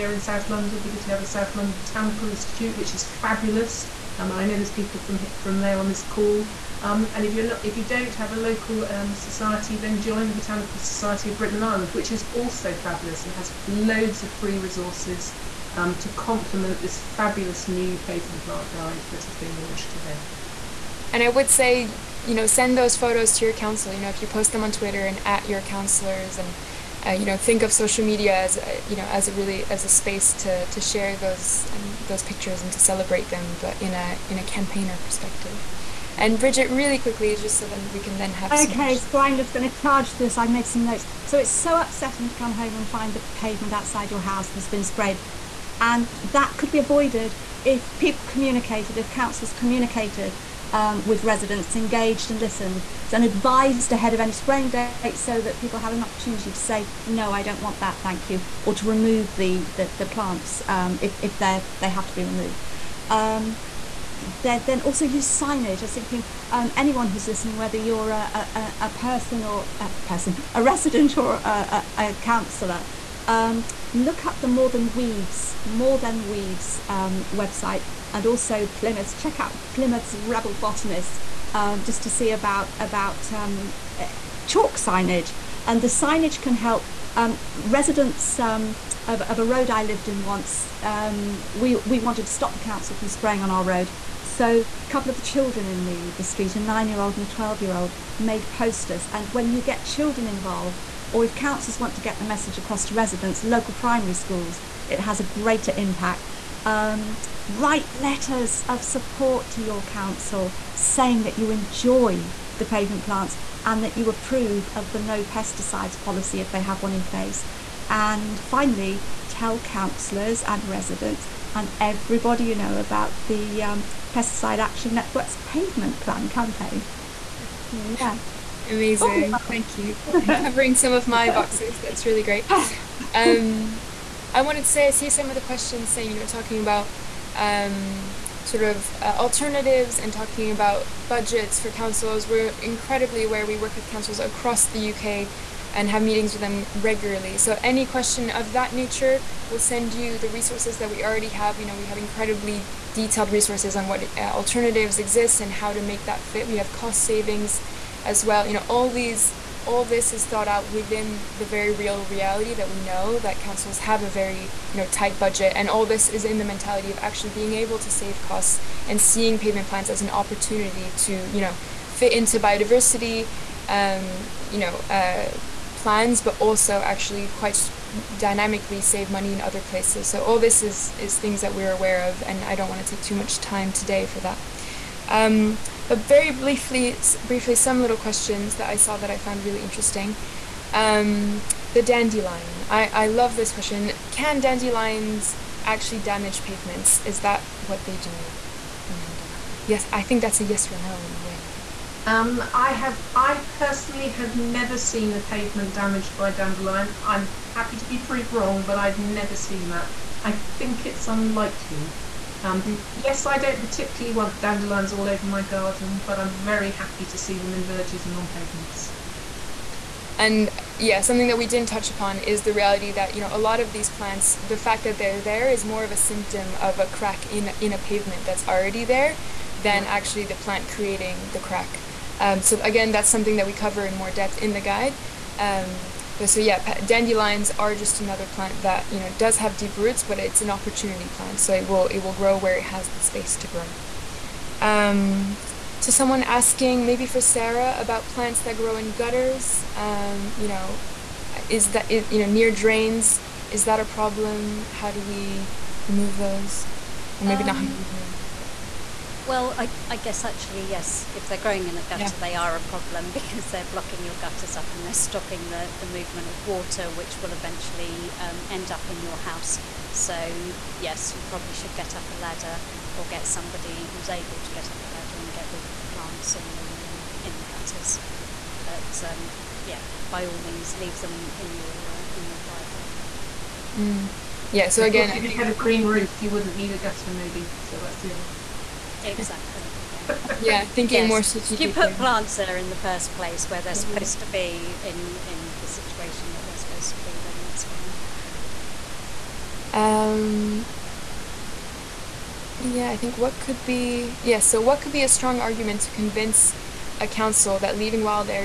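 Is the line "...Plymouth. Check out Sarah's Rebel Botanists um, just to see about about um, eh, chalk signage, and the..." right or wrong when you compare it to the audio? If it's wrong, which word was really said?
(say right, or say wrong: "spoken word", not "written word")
wrong: "Plymouth", not "Sarah".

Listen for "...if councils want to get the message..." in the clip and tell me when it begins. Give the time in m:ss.
1:41.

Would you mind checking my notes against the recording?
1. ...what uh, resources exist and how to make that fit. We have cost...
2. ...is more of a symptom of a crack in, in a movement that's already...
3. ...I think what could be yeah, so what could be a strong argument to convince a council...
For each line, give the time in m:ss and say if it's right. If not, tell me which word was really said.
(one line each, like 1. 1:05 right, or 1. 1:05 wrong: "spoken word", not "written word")
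1. 2:33 wrong: "alternatives", not "resources"
2. 3:45 wrong: "pavement", not "movement"
3. 5:02 right.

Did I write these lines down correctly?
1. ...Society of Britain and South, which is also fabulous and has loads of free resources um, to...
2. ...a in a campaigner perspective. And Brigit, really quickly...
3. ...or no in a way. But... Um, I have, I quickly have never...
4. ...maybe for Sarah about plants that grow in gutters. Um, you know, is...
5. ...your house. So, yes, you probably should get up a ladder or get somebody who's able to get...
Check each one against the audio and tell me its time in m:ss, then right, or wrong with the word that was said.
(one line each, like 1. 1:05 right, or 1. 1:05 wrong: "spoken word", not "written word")
1. 0:10 wrong: "Ireland", not "South"
2. 0:33 right
3. 3:20 wrong: "personally", not "quickly"
4. 4:06 right
5. 4:29 right.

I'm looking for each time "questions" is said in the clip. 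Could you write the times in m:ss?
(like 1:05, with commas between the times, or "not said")
2:15, 2:27, 3:07, 3:13.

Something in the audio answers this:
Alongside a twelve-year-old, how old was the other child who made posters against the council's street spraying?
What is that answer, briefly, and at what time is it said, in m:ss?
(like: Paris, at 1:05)
9, at 1:36.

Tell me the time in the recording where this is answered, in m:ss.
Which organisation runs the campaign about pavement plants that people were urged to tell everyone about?
2:04.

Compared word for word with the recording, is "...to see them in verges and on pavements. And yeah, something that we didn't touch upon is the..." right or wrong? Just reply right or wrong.
right.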